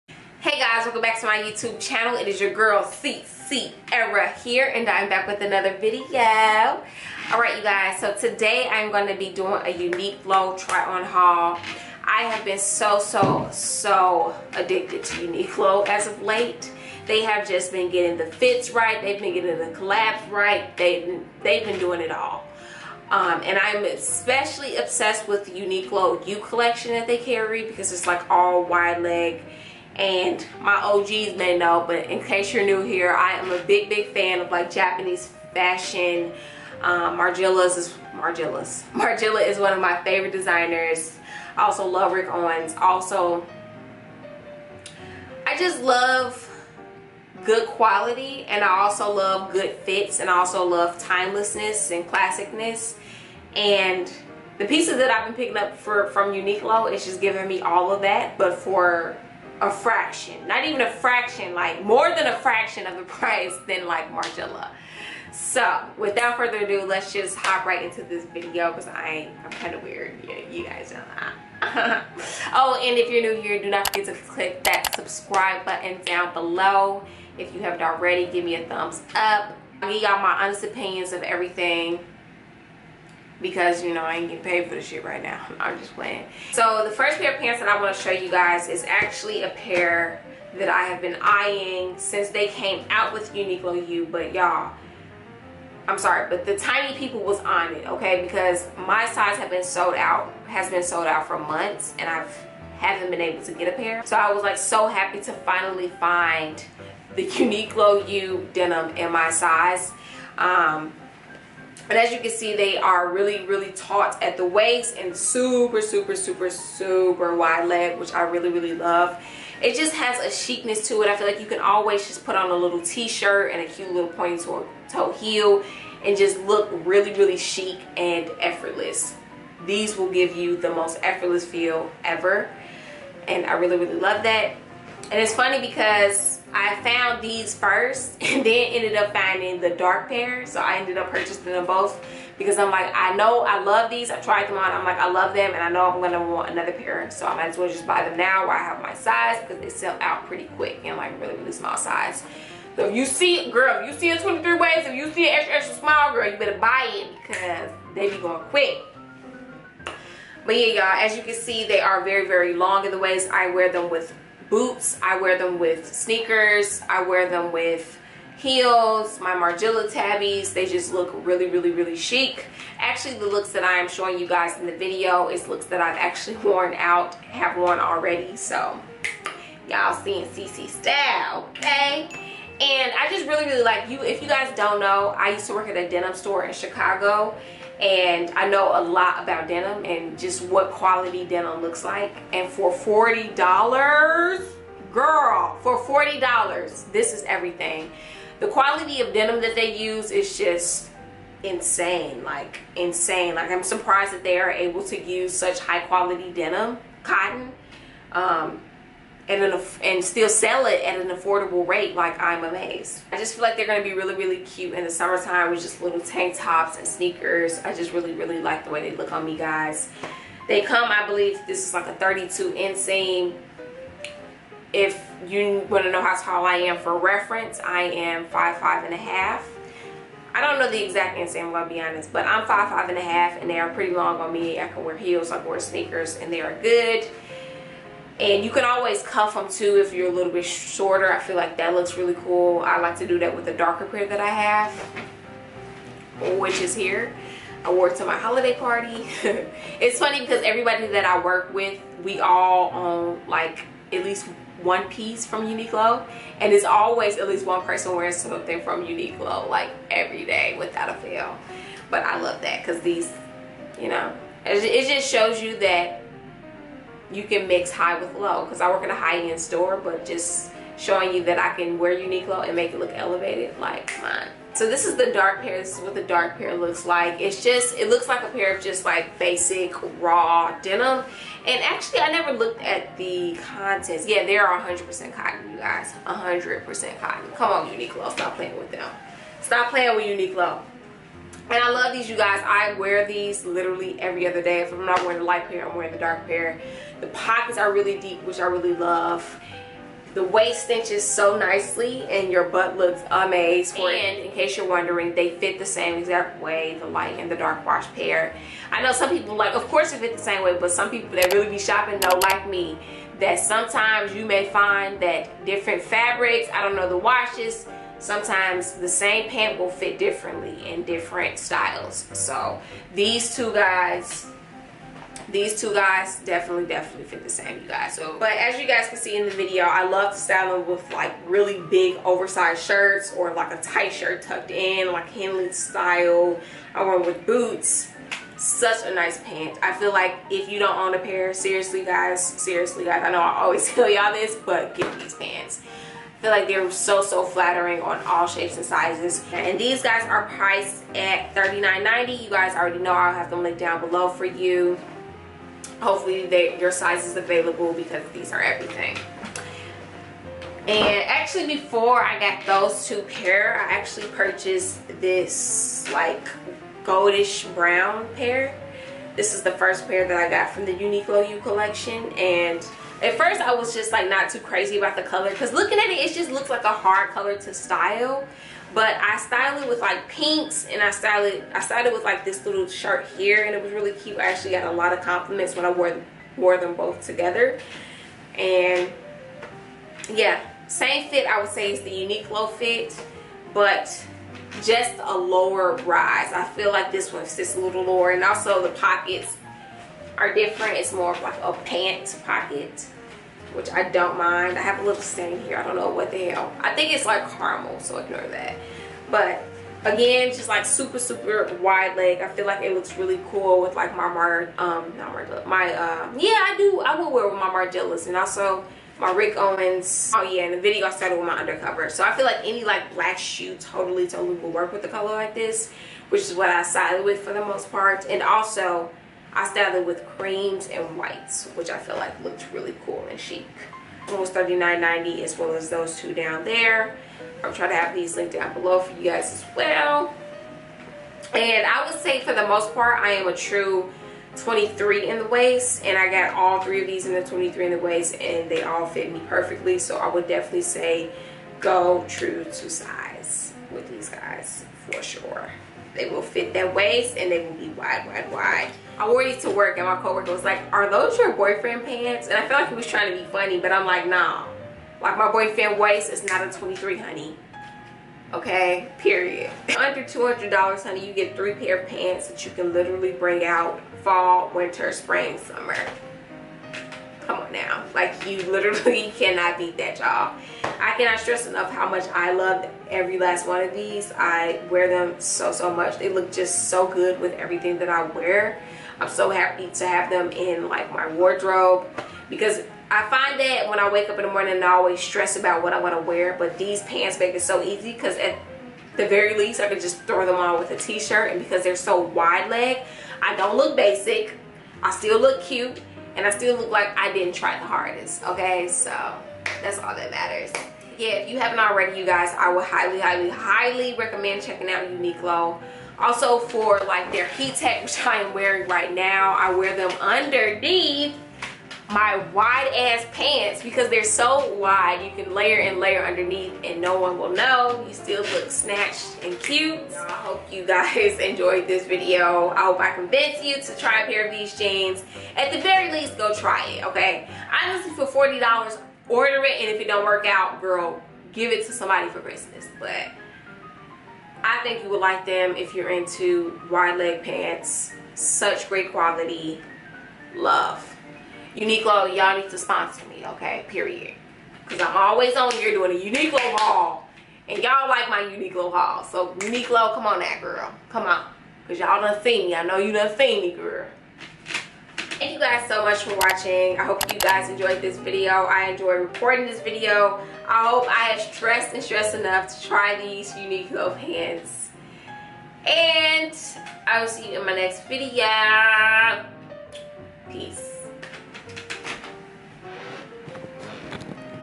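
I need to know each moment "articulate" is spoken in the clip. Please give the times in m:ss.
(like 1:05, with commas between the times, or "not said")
not said.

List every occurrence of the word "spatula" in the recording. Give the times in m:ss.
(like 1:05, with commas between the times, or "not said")
not said.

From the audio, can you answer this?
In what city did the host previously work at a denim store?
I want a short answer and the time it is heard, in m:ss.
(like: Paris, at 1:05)
Chicago, at 3:06.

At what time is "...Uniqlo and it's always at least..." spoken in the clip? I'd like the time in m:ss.
4:15.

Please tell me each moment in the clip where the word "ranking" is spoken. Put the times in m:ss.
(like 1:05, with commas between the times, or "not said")
not said.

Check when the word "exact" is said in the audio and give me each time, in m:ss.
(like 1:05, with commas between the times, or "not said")
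3:50, 5:05.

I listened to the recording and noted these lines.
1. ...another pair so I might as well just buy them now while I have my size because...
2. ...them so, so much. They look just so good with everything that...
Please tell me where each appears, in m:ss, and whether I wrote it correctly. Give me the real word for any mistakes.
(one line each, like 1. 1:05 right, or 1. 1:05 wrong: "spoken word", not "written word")
1. 2:26 right
2. 8:04 right.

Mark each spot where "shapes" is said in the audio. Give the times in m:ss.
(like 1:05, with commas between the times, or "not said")
5:48.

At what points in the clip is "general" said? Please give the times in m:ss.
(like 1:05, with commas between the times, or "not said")
not said.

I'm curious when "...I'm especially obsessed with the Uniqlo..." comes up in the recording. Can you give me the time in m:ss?
0:23.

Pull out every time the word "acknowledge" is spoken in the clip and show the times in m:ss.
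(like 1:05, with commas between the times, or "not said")
not said.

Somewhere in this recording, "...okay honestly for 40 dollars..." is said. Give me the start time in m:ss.
8:56.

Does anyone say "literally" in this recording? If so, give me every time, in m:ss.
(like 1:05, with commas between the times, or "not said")
4:53, 7:52, 7:58.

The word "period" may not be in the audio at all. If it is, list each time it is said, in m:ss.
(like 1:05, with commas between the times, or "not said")
7:48, 9:13.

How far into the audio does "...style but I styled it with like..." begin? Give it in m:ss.
6:17.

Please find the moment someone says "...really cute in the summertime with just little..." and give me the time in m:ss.
3:34.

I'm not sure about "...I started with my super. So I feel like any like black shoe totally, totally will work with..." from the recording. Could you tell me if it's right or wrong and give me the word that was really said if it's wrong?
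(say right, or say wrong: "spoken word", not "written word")
wrong: "undercover", not "super".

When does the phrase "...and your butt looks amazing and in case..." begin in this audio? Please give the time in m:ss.
5:02.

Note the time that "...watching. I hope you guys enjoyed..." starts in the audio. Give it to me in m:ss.
9:26.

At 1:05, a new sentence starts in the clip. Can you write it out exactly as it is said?
So without further ado, let's just hop right into this video because I I'm kind of weird.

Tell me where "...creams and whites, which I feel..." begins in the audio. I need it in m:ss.
7:10.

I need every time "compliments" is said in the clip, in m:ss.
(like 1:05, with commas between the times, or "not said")
6:25.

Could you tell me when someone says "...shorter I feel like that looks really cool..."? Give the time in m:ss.
4:00.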